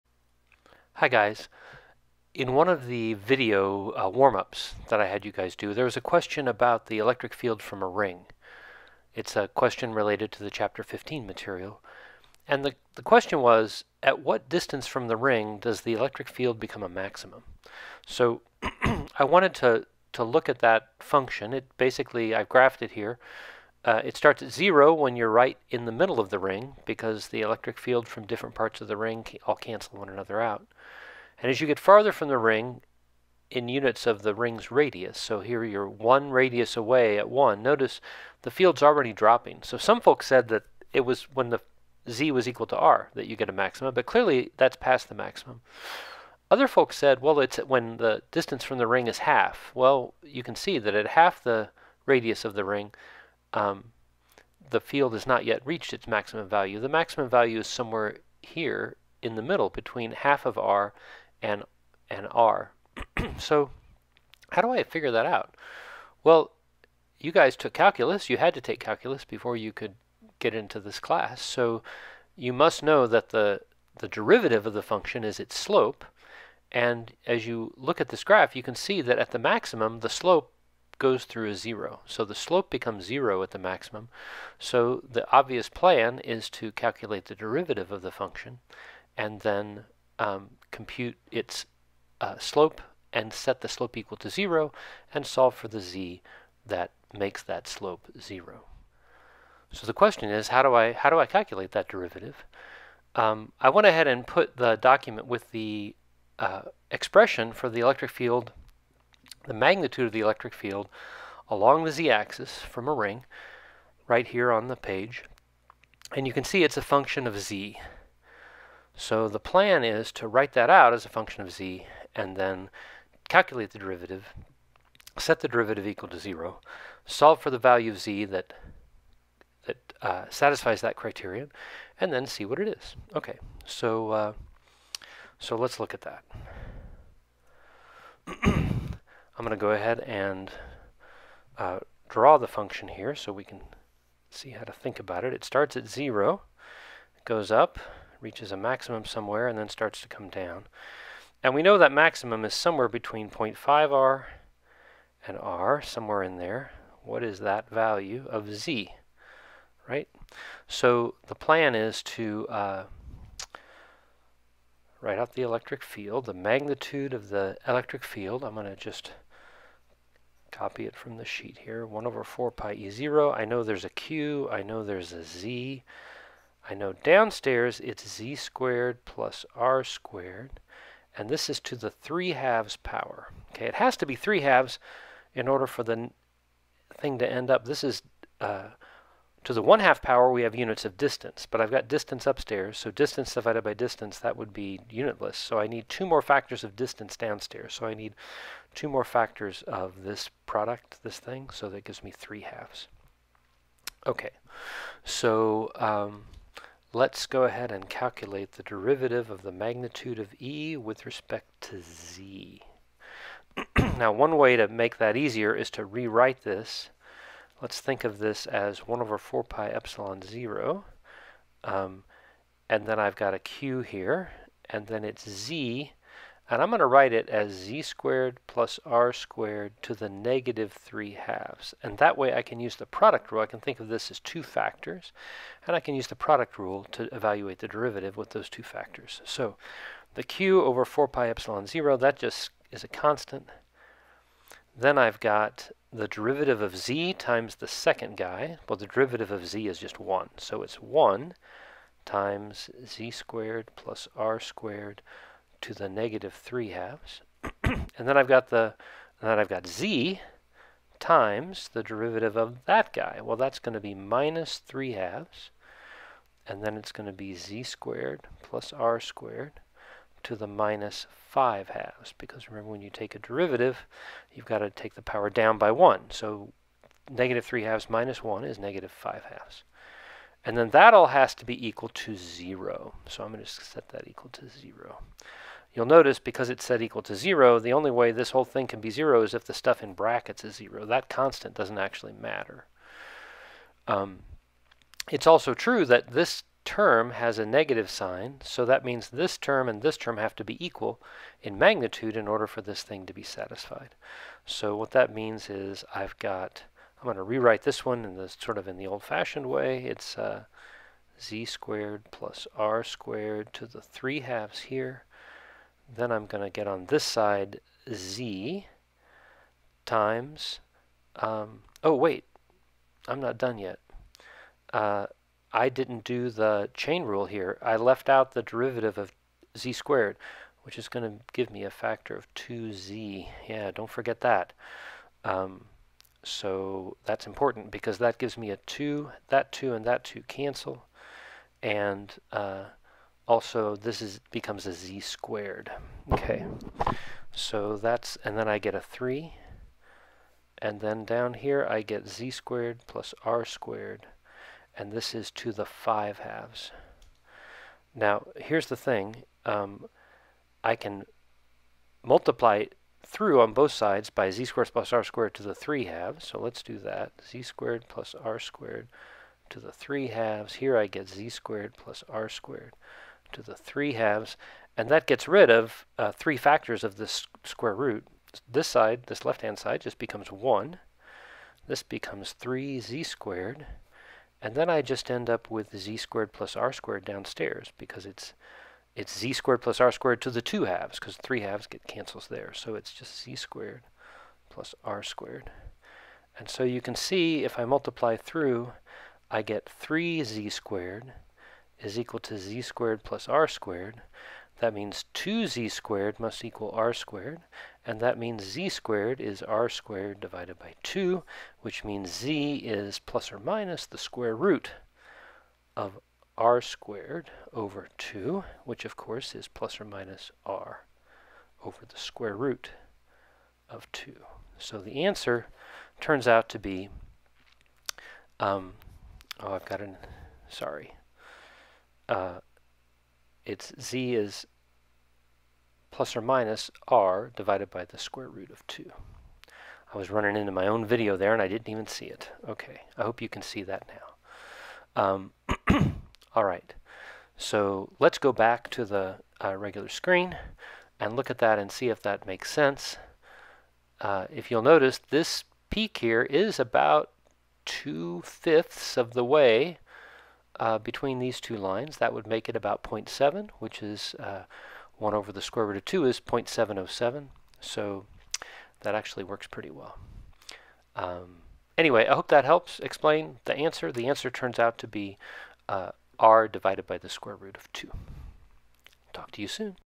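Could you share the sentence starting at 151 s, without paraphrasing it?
And we know that maximum is somewhere between 0.5r and r, somewhere in there.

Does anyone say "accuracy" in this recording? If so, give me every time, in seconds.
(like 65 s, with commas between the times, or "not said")
not said.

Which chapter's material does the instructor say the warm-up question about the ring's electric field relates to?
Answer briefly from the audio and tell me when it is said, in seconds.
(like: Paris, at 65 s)
Chapter 15, at 10 s.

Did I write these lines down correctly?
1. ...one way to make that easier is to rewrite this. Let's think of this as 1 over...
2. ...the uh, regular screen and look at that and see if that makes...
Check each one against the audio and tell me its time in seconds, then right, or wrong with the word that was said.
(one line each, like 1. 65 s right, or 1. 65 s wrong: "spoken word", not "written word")
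1. 214 s right
2. 448 s right.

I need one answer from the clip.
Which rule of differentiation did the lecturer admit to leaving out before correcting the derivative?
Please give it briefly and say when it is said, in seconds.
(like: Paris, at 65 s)
chain rule, at 326 s.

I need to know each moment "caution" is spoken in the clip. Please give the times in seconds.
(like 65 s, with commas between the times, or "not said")
not said.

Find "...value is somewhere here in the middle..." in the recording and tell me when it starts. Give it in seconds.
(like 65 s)
57 s.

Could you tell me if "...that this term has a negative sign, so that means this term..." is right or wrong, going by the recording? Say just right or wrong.
right.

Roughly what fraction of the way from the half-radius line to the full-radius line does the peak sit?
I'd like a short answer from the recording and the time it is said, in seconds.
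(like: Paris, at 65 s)
two-fifths, at 457 s.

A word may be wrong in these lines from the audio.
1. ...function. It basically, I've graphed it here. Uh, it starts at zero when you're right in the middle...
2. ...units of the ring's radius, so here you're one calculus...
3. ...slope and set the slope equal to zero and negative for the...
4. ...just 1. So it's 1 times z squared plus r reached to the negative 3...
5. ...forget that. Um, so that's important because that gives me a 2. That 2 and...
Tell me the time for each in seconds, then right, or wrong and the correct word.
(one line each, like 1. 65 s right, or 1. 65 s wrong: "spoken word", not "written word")
1. 20 s right
2. 33 s wrong: "radius", not "calculus"
3. 92 s wrong: "solve", not "negative"
4. 249 s wrong: "squared", not "reached"
5. 333 s right.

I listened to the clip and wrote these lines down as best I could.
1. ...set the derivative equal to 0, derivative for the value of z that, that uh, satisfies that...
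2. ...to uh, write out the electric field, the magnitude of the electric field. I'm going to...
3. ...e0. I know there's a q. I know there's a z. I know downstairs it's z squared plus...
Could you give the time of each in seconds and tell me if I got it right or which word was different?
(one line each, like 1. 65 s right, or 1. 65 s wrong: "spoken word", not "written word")
1. 125 s wrong: "solve", not "derivative"
2. 162 s right
3. 172 s right.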